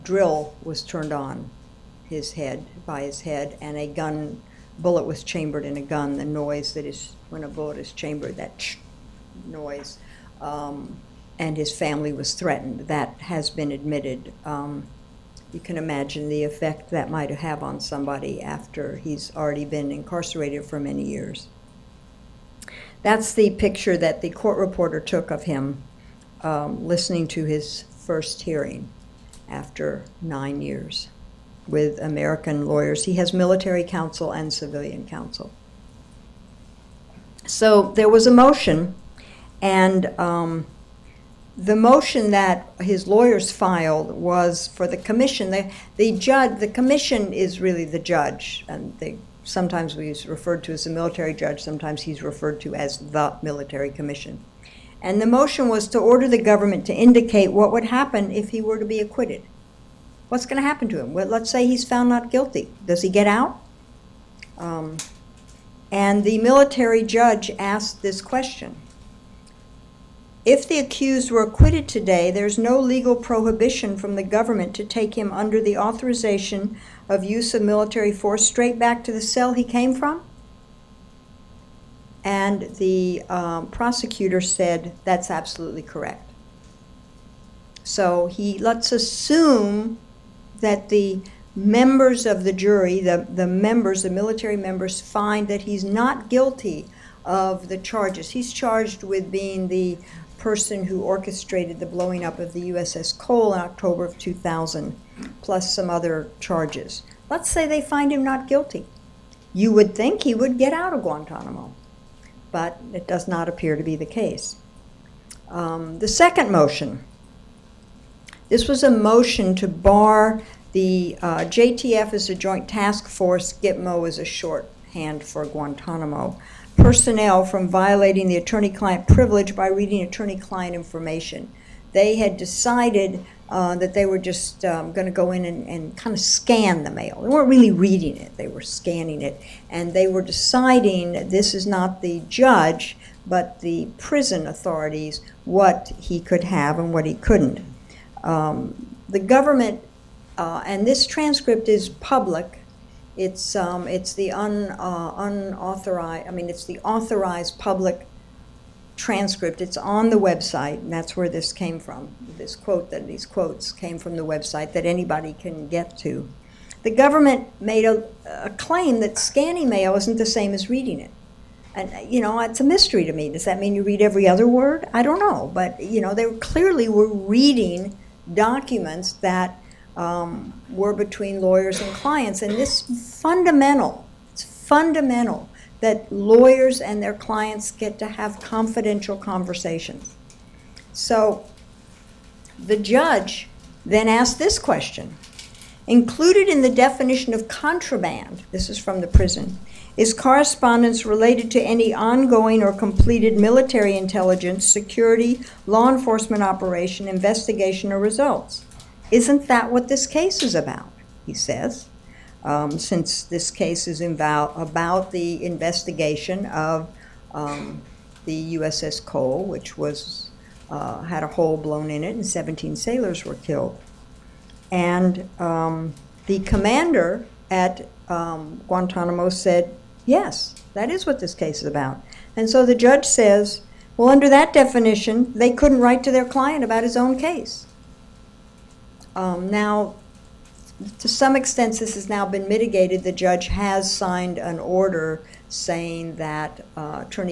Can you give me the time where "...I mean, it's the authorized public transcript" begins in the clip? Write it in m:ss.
2:36.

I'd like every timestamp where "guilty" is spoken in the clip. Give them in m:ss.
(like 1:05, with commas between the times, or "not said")
1:02, 1:36, 1:48.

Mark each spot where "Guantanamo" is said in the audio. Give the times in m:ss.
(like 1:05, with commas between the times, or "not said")
1:51, 2:05, 3:48.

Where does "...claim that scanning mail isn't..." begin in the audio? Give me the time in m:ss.
2:48.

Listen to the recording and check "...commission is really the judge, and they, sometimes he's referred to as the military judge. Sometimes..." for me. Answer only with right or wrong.
right.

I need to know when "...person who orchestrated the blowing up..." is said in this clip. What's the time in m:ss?
1:40.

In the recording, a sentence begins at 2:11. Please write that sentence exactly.
They had decided uh, that they were just um, going to go in and, and kind of scan the mail.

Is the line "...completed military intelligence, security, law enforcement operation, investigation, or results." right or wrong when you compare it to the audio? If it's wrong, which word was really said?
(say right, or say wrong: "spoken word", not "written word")
right.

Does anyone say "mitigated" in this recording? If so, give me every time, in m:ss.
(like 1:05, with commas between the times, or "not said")
4:02.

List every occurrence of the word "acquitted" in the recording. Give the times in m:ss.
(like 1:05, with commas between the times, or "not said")
0:59, 1:11.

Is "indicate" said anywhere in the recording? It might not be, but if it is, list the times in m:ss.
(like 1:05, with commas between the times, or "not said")
0:56.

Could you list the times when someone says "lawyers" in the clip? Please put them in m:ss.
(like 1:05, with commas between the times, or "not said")
0:32, 0:43, 3:01, 3:06.